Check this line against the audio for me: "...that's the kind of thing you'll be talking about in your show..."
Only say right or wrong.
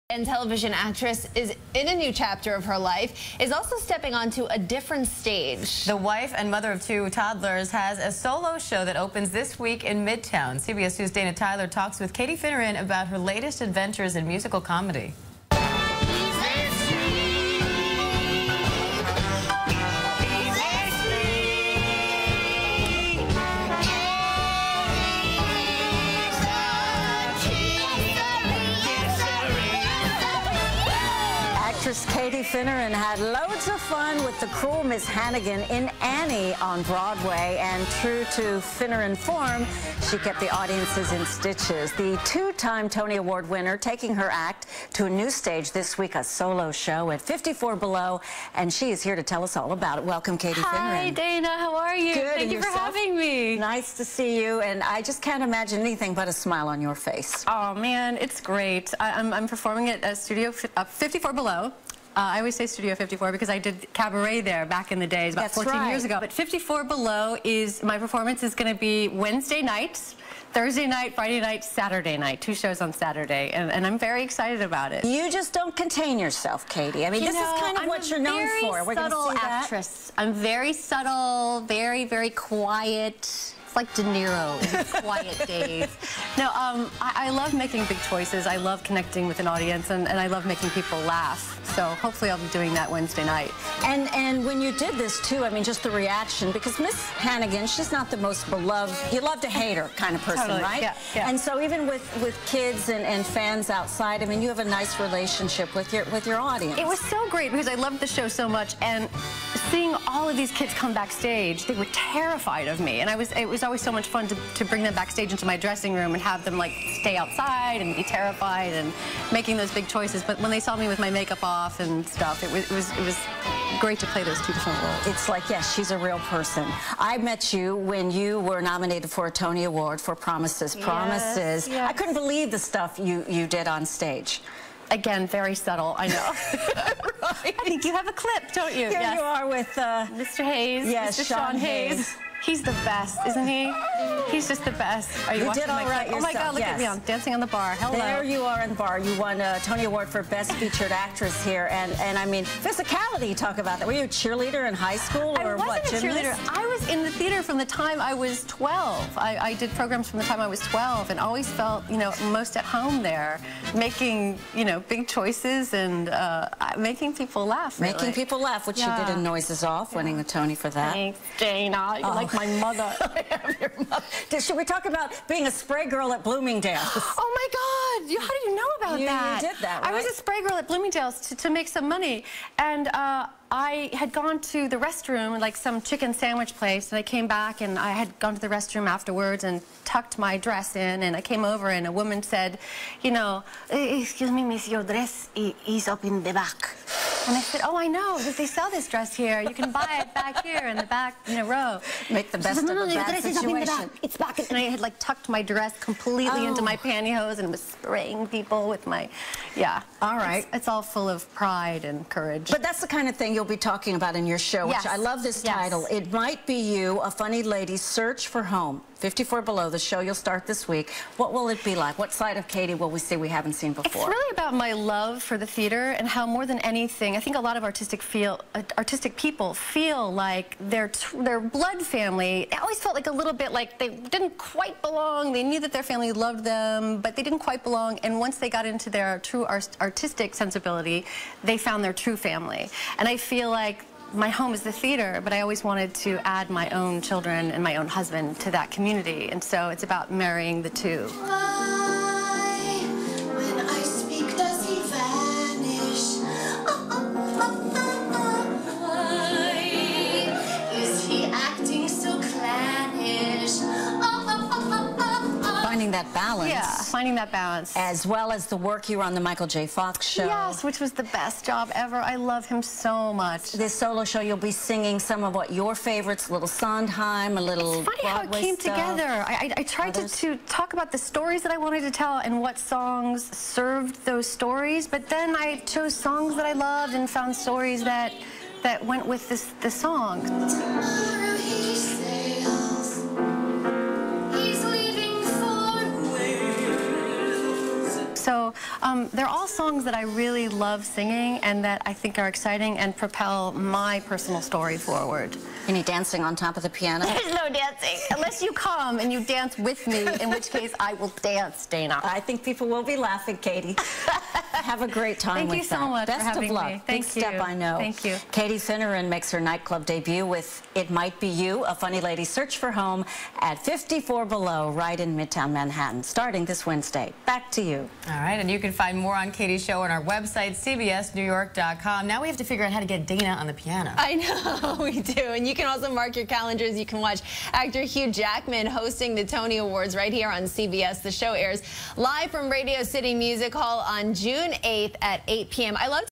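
right.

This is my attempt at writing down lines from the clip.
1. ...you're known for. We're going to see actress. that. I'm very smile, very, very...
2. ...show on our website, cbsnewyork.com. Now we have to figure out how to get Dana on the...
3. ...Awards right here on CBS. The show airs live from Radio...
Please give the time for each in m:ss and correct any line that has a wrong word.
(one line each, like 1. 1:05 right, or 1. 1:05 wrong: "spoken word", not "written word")
1. 1:18 wrong: "subtle", not "smile"
2. 5:29 right
3. 5:39 right.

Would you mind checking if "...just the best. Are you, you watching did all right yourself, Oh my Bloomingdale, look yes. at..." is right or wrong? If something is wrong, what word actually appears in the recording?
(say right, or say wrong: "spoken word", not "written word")
wrong: "God", not "Bloomingdale".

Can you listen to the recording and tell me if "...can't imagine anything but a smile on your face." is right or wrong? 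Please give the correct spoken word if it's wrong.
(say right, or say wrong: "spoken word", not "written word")
right.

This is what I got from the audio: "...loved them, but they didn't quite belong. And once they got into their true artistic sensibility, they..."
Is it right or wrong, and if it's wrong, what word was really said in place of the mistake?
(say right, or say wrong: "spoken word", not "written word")
right.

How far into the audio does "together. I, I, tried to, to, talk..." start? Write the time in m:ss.
4:38.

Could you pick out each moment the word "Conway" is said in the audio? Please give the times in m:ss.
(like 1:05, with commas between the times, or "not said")
not said.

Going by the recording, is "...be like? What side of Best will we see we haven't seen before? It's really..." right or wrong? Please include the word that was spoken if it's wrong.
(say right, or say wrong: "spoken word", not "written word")
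wrong: "Katie", not "Best".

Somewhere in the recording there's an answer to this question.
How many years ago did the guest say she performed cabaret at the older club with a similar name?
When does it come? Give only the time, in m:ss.
1:05.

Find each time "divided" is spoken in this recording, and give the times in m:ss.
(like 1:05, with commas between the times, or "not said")
not said.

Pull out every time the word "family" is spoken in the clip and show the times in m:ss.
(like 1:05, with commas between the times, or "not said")
3:51, 3:55, 4:02.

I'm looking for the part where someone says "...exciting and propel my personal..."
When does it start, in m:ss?
5:02.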